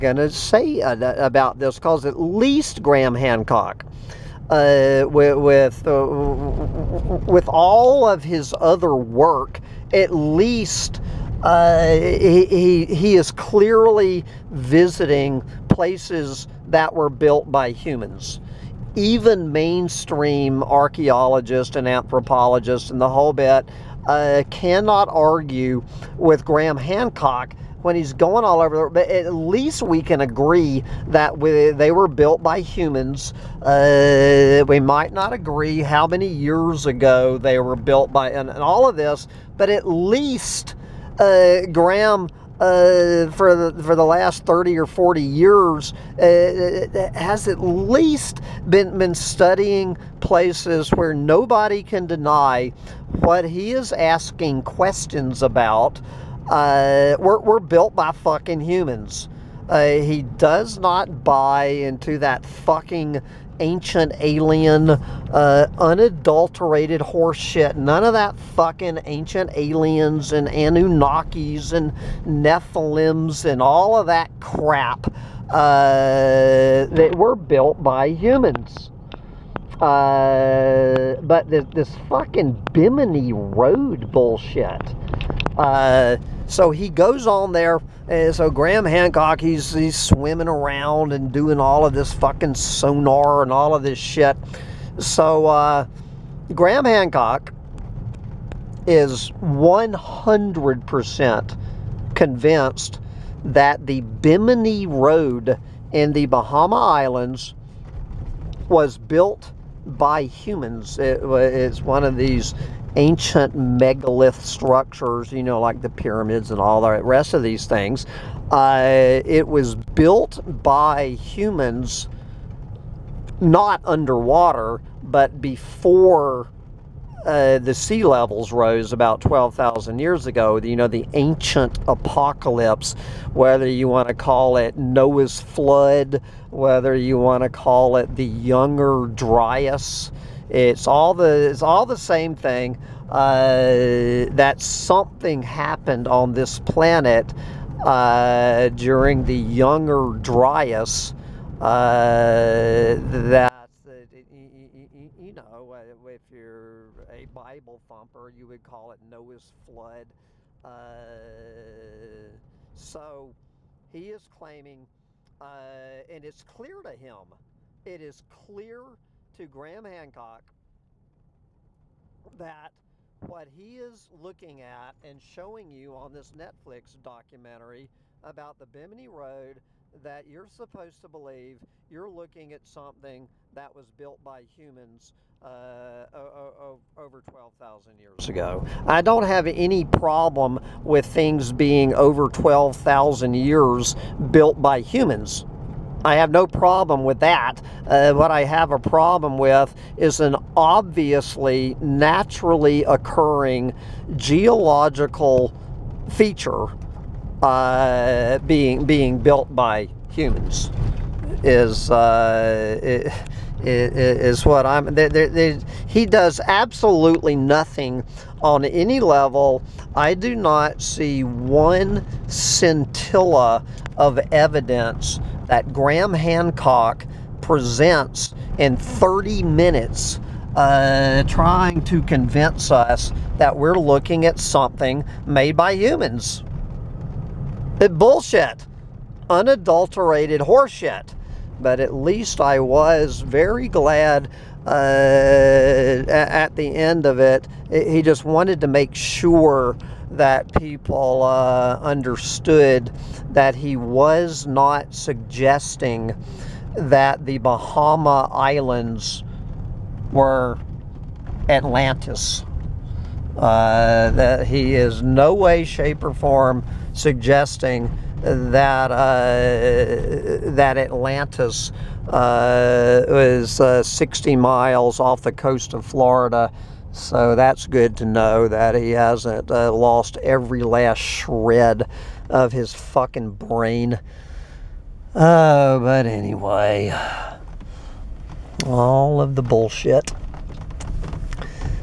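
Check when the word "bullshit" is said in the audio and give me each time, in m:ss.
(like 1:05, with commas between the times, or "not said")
1:24, 3:57, 4:49.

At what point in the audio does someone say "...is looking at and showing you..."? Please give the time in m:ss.
2:53.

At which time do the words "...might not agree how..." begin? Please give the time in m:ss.
0:34.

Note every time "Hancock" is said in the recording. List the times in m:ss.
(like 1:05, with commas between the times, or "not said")
0:03, 0:26, 1:28, 1:36, 2:49, 3:46.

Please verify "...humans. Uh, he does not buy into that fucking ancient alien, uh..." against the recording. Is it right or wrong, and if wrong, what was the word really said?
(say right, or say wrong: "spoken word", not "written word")
right.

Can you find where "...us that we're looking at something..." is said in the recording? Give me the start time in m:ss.
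3:52.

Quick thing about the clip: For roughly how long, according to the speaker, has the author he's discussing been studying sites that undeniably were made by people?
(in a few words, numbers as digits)
30 or 40 years.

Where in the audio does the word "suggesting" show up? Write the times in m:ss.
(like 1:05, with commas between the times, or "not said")
4:14, 4:26.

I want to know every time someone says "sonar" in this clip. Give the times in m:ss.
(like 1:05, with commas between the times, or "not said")
1:32.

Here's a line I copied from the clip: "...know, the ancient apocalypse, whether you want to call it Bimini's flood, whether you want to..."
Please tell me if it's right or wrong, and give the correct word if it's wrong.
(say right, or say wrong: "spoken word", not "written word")
wrong: "Noah", not "Bimini".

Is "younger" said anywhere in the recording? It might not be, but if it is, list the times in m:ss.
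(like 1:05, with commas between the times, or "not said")
2:18, 2:29.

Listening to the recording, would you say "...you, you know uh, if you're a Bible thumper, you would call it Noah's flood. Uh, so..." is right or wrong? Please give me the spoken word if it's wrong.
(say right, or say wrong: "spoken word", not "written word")
right.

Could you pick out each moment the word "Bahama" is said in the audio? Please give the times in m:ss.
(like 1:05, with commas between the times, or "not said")
1:46, 4:17.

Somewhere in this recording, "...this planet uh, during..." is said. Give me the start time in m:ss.
2:26.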